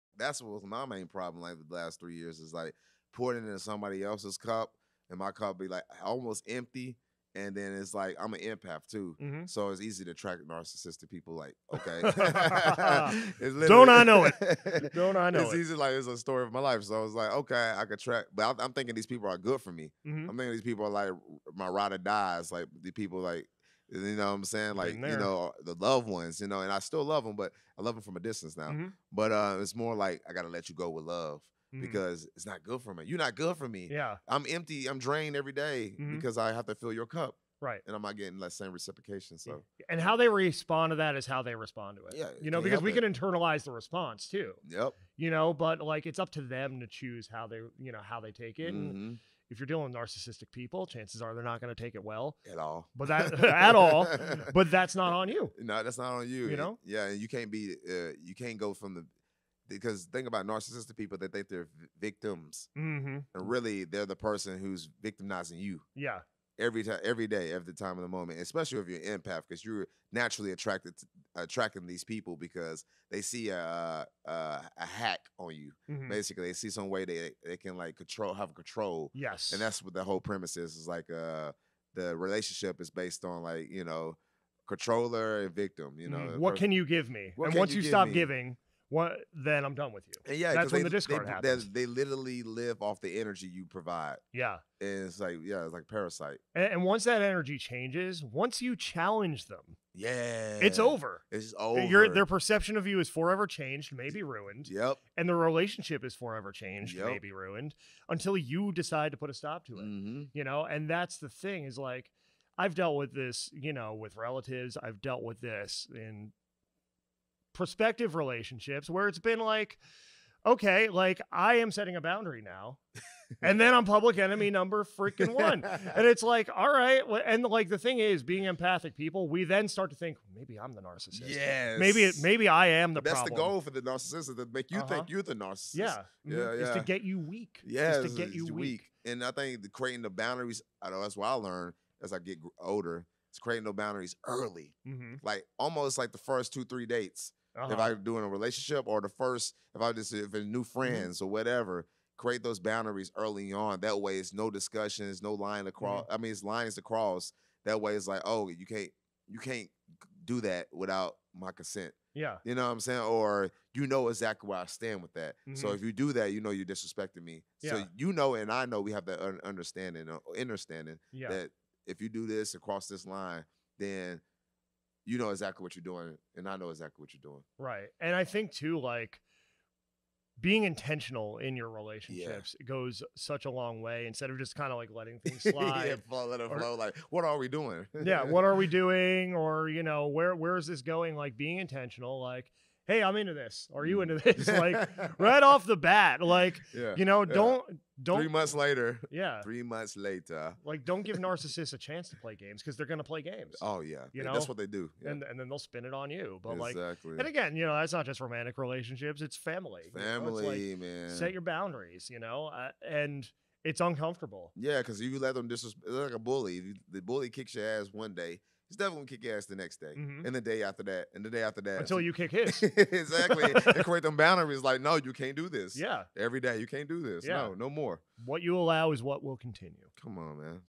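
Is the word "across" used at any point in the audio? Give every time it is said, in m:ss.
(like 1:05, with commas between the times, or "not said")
2:35, 2:52.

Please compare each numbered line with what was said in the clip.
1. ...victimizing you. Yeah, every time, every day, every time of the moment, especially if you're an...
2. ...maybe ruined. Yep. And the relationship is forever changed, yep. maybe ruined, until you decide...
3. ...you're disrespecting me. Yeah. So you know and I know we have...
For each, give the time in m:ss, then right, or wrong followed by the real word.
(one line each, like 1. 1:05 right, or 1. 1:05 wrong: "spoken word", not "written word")
1. 1:05 right
2. 1:43 right
3. 2:46 right.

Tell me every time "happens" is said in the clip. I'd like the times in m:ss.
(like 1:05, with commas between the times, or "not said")
1:31.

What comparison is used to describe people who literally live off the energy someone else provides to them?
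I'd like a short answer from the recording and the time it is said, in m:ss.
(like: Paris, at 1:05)
parasite, at 1:35.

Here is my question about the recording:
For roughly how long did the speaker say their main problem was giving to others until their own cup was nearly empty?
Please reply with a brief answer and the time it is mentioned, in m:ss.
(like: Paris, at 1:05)
the last three years, at 0:01.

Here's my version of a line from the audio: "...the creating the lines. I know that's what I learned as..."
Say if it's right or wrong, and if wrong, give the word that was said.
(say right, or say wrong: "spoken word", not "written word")
wrong: "boundaries", not "lines".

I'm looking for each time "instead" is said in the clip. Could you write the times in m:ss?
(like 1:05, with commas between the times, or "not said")
3:04.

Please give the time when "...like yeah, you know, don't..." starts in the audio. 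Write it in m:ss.
3:16.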